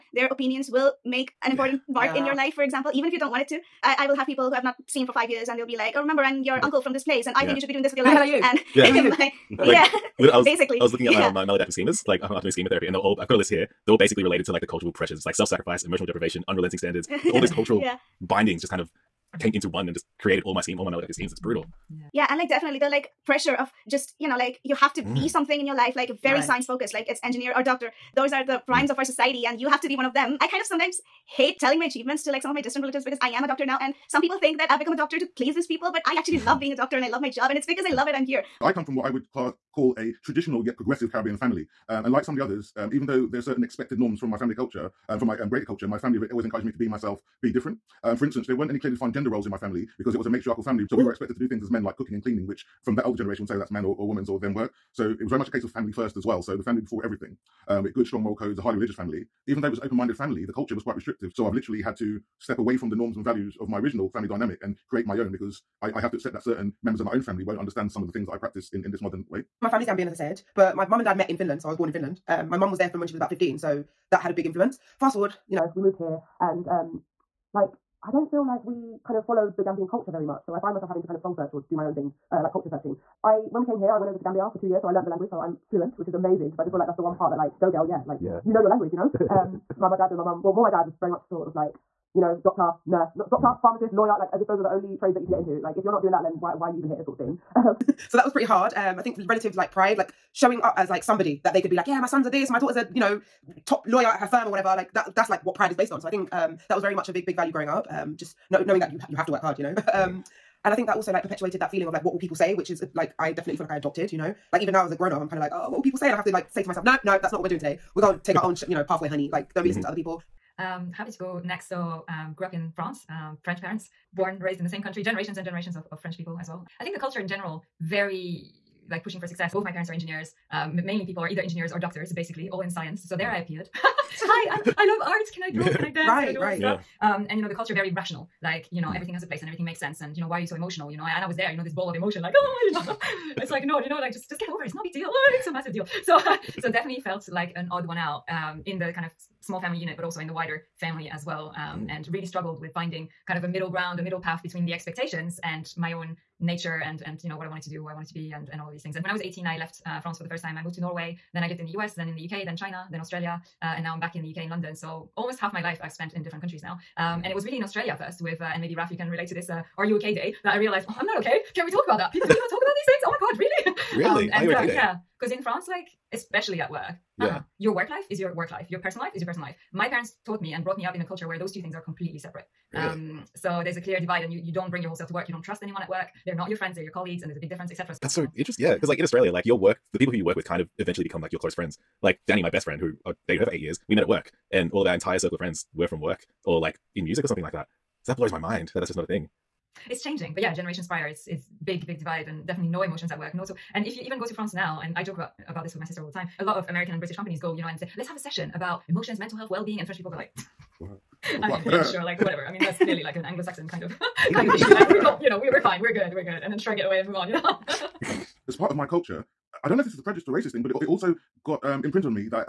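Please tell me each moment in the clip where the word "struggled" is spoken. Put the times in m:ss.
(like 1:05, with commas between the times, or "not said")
2:32.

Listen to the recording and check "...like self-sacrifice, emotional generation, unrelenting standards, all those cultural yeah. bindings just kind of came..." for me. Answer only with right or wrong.
wrong.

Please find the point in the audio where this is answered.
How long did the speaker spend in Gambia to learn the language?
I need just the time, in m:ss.
1:24.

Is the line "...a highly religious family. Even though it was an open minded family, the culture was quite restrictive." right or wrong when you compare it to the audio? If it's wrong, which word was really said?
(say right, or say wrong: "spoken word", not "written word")
right.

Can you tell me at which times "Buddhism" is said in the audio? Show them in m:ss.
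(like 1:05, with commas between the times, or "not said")
not said.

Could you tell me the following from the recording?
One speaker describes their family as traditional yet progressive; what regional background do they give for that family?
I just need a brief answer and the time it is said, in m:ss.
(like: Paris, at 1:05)
Caribbean, at 0:41.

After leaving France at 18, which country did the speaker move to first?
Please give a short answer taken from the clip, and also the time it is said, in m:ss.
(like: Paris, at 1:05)
Norway, at 2:40.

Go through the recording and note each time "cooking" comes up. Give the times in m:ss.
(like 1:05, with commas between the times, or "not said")
0:51.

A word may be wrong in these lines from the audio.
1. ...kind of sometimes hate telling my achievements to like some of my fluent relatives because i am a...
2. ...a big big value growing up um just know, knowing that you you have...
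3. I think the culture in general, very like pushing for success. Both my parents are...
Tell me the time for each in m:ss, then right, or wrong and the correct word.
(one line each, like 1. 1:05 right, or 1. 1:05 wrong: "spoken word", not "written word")
1. 0:30 wrong: "distant", not "fluent"
2. 1:47 right
3. 2:06 right.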